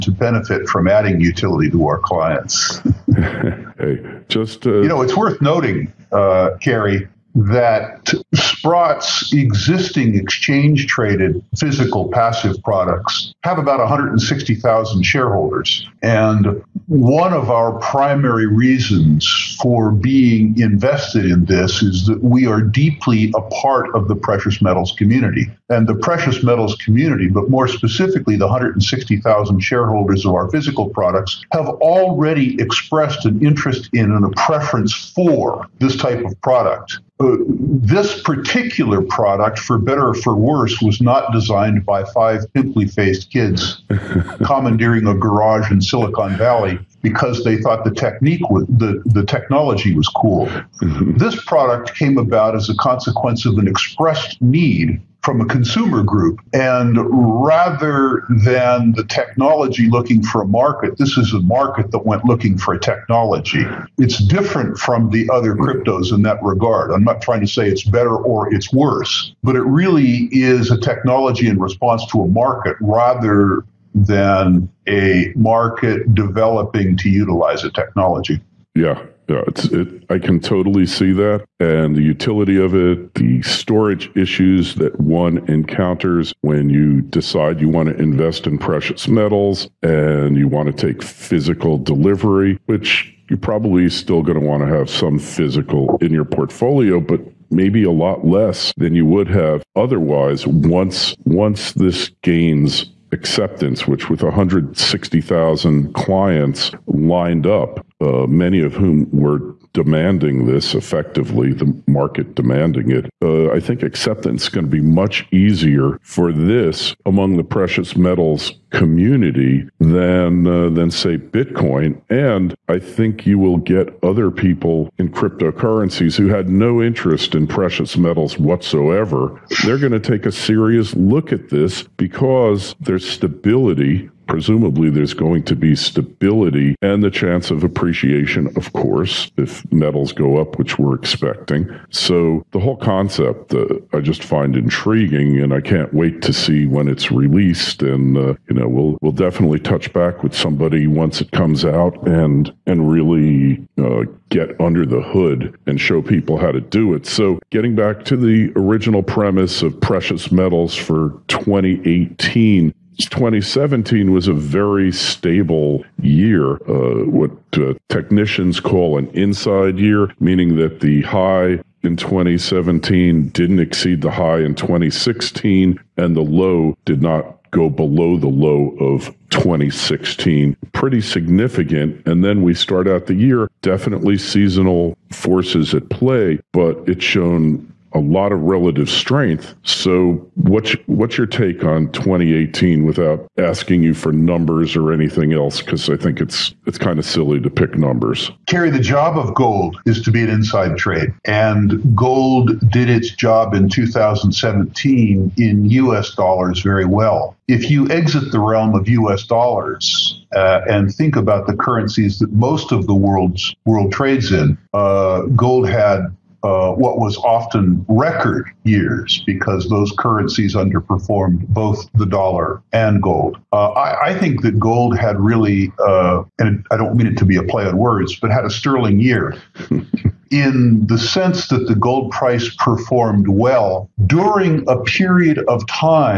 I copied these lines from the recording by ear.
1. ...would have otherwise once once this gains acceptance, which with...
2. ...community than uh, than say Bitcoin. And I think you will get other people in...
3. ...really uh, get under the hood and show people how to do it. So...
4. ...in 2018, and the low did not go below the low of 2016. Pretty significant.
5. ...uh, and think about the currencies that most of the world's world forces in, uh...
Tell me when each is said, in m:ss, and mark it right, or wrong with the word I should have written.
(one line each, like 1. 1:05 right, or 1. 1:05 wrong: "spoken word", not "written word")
1. 1:39 right
2. 1:58 right
3. 2:32 right
4. 2:54 wrong: "2016", not "2018"
5. 3:30 wrong: "trades", not "forces".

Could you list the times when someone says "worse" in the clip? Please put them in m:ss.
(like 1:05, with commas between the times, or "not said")
0:40, 1:08.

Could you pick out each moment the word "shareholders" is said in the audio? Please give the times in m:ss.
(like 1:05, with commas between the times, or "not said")
0:15, 0:29.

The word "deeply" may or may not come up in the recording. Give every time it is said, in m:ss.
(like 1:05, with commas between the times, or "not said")
0:22.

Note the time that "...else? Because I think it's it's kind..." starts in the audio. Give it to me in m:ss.
3:15.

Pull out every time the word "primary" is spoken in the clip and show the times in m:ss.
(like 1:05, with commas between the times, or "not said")
0:17.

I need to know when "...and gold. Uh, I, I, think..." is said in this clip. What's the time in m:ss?
3:42.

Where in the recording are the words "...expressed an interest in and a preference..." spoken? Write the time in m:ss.
0:32.